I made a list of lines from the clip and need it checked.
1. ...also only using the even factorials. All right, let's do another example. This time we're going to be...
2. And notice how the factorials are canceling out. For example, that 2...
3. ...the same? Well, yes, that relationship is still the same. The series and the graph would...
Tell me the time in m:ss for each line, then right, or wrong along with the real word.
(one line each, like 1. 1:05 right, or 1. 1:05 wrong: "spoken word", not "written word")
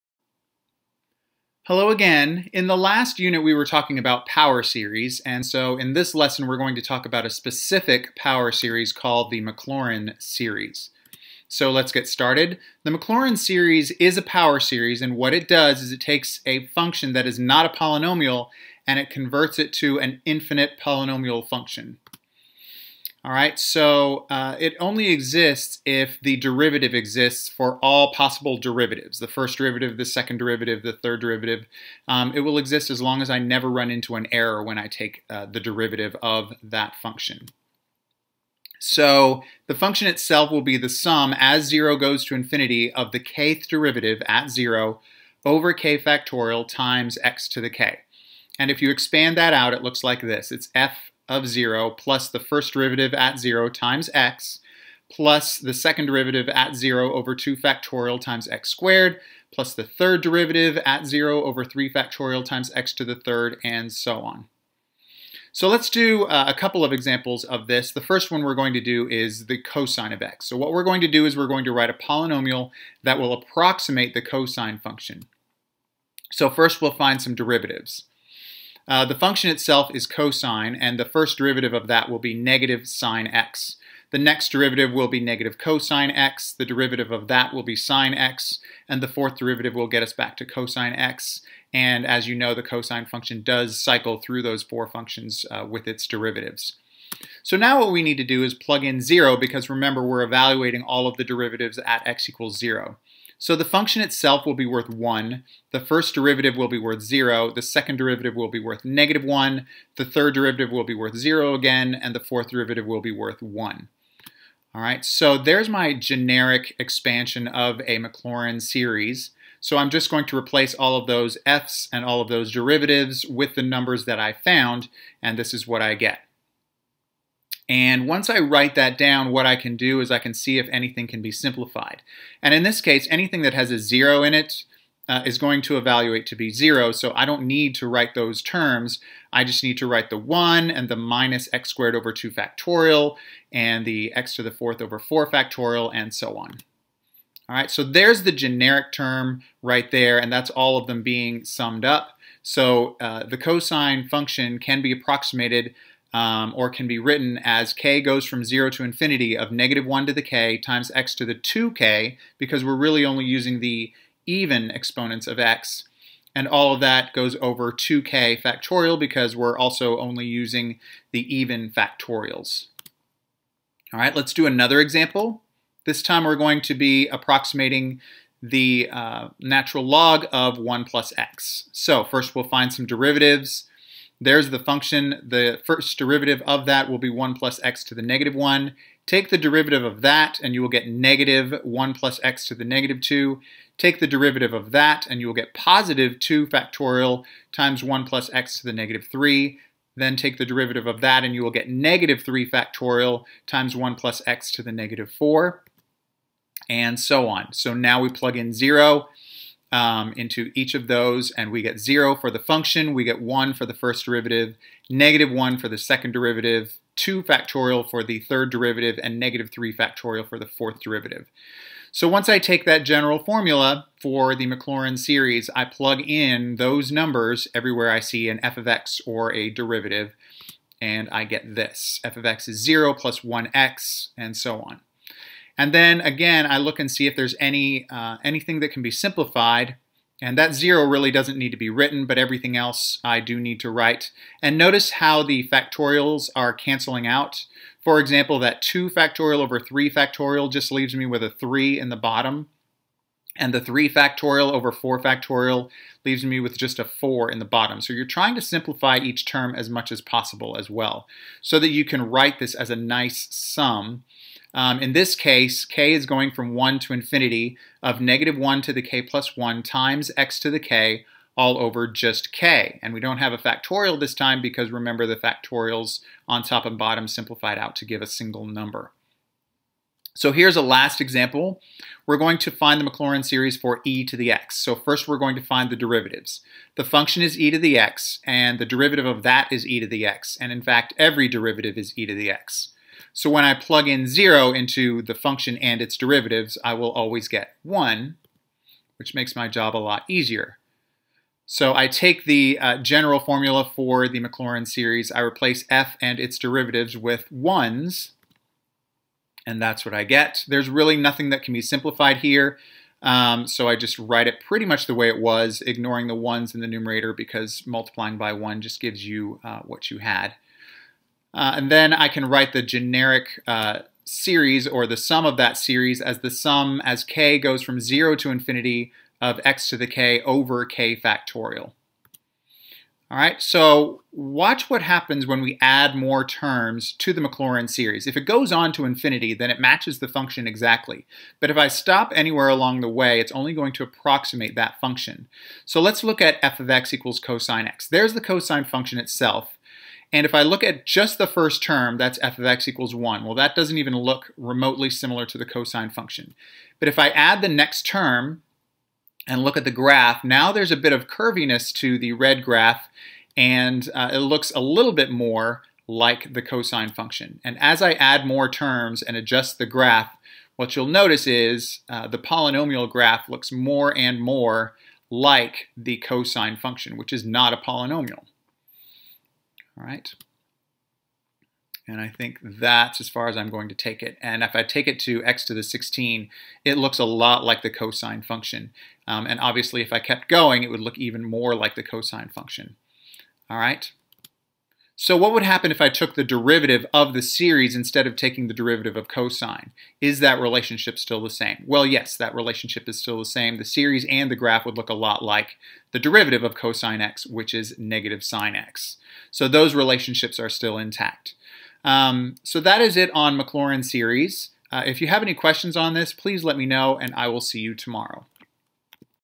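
1. 2:49 right
2. 4:04 right
3. 6:41 right.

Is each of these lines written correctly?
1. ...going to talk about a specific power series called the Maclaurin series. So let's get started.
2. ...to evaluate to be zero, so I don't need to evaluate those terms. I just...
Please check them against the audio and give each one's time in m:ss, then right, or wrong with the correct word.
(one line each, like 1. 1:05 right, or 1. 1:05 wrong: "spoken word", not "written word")
1. 0:06 right
2. 2:15 wrong: "write", not "evaluate".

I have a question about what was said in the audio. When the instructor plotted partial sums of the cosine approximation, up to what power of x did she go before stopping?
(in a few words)
x to the 16.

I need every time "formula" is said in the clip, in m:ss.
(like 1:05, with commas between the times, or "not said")
3:43, 5:03.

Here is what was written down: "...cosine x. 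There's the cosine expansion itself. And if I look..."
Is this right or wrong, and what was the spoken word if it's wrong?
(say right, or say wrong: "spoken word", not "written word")
wrong: "function", not "expansion".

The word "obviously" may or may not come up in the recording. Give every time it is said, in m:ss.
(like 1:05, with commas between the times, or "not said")
6:29.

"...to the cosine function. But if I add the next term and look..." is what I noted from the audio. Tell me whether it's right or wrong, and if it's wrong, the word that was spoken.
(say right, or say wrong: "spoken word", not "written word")
right.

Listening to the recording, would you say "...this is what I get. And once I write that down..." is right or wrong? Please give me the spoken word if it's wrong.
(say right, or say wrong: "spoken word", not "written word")
right.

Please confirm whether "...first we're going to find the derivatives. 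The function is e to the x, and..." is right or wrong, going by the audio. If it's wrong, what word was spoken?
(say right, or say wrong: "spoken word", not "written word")
right.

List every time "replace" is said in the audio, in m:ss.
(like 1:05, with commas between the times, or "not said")
2:00, 5:05.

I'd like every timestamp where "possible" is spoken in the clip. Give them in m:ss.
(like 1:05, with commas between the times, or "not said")
0:28, 4:20.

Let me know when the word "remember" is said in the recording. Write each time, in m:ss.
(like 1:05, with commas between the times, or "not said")
1:39, 4:34.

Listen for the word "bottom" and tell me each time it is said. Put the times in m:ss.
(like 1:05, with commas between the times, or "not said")
4:11, 4:17, 4:36.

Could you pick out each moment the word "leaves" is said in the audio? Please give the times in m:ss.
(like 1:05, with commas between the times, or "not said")
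4:10, 4:16.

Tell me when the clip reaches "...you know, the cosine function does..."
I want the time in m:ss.
1:32.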